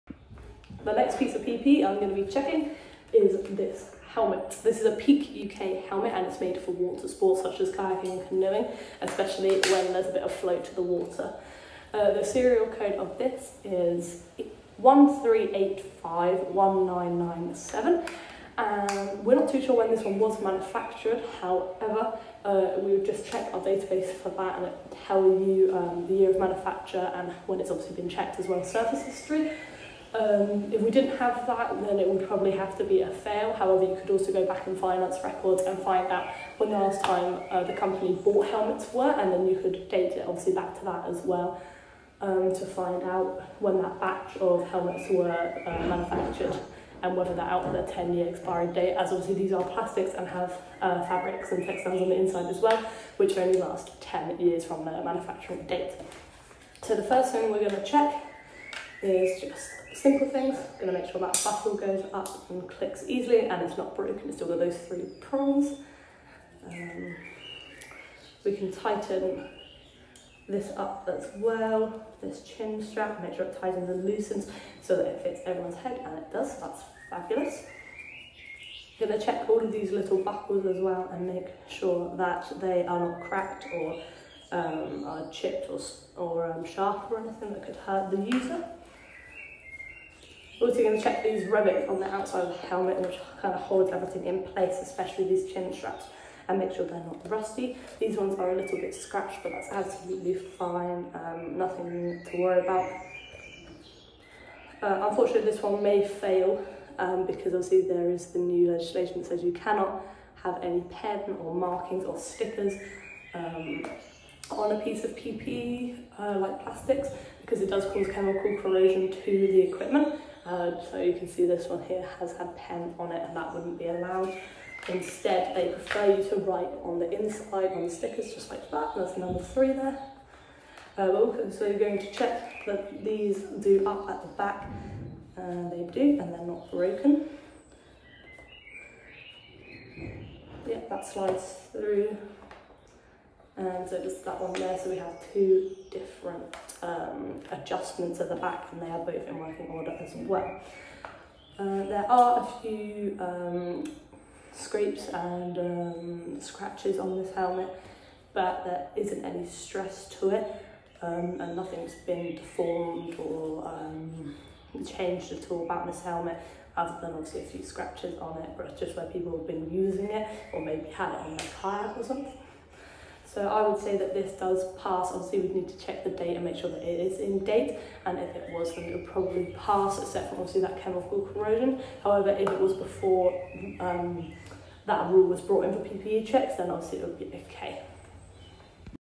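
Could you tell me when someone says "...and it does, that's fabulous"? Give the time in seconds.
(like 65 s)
76 s.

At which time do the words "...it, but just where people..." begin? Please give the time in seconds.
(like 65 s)
168 s.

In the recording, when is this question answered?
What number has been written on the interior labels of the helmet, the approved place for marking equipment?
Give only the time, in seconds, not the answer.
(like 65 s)
129 s.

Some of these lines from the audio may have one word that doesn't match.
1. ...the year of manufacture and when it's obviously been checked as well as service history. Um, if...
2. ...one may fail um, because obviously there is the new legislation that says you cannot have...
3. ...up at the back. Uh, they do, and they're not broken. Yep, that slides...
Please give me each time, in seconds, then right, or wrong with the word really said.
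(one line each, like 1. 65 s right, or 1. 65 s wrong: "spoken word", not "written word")
1. 26 s right
2. 105 s right
3. 133 s right.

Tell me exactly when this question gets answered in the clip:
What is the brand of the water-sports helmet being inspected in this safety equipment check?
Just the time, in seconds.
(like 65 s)
4 s.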